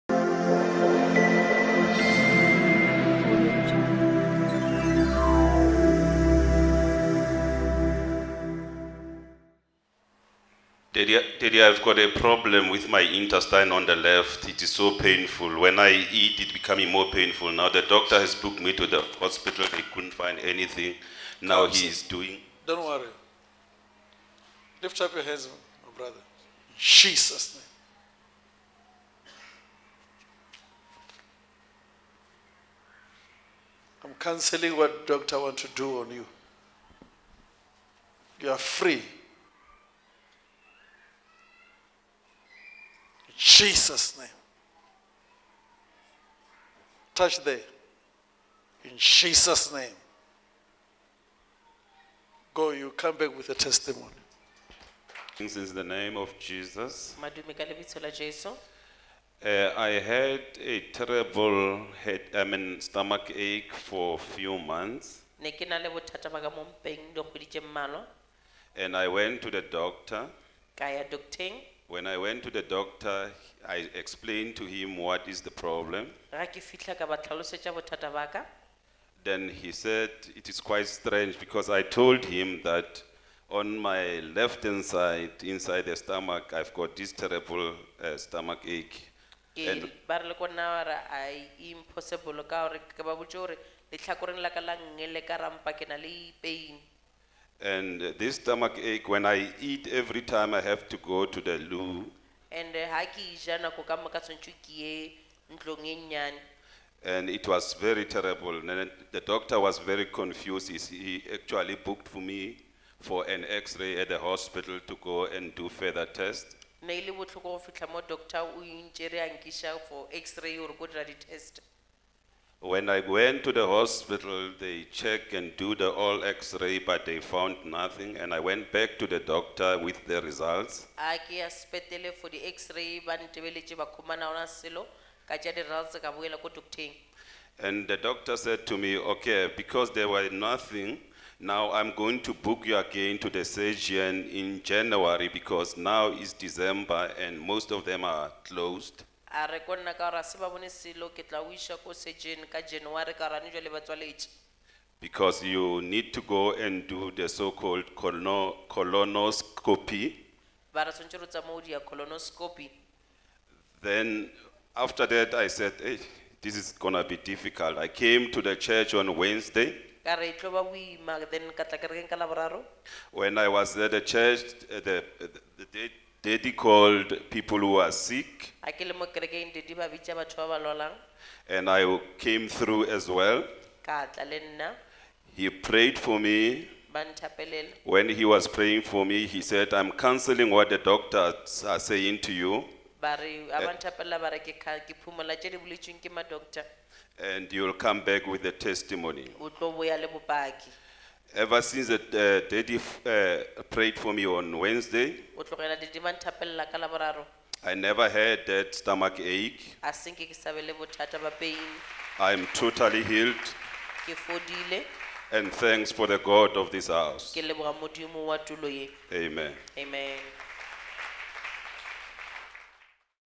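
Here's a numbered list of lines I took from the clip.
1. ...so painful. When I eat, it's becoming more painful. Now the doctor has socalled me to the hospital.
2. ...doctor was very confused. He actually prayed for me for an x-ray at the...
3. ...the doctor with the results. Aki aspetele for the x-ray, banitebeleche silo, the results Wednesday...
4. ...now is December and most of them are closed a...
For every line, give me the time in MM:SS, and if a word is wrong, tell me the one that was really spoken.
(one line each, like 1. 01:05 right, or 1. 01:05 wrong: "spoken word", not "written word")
1. 00:14 wrong: "booked", not "socalled"
2. 01:49 wrong: "booked", not "prayed"
3. 02:09 wrong: "And", not "Wednesday"
4. 02:25 right.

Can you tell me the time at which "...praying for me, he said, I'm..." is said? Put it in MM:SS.
03:08.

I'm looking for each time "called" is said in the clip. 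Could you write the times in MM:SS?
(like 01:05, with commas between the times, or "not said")
02:37, 02:56.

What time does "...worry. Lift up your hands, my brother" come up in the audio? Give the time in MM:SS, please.
00:22.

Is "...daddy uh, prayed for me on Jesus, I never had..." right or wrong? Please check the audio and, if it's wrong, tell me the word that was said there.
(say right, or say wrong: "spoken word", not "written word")
wrong: "Wednesday", not "Jesus".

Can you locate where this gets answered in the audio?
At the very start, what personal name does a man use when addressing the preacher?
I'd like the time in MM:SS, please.
00:11.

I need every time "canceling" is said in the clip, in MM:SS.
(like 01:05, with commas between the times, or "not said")
00:34, 03:09.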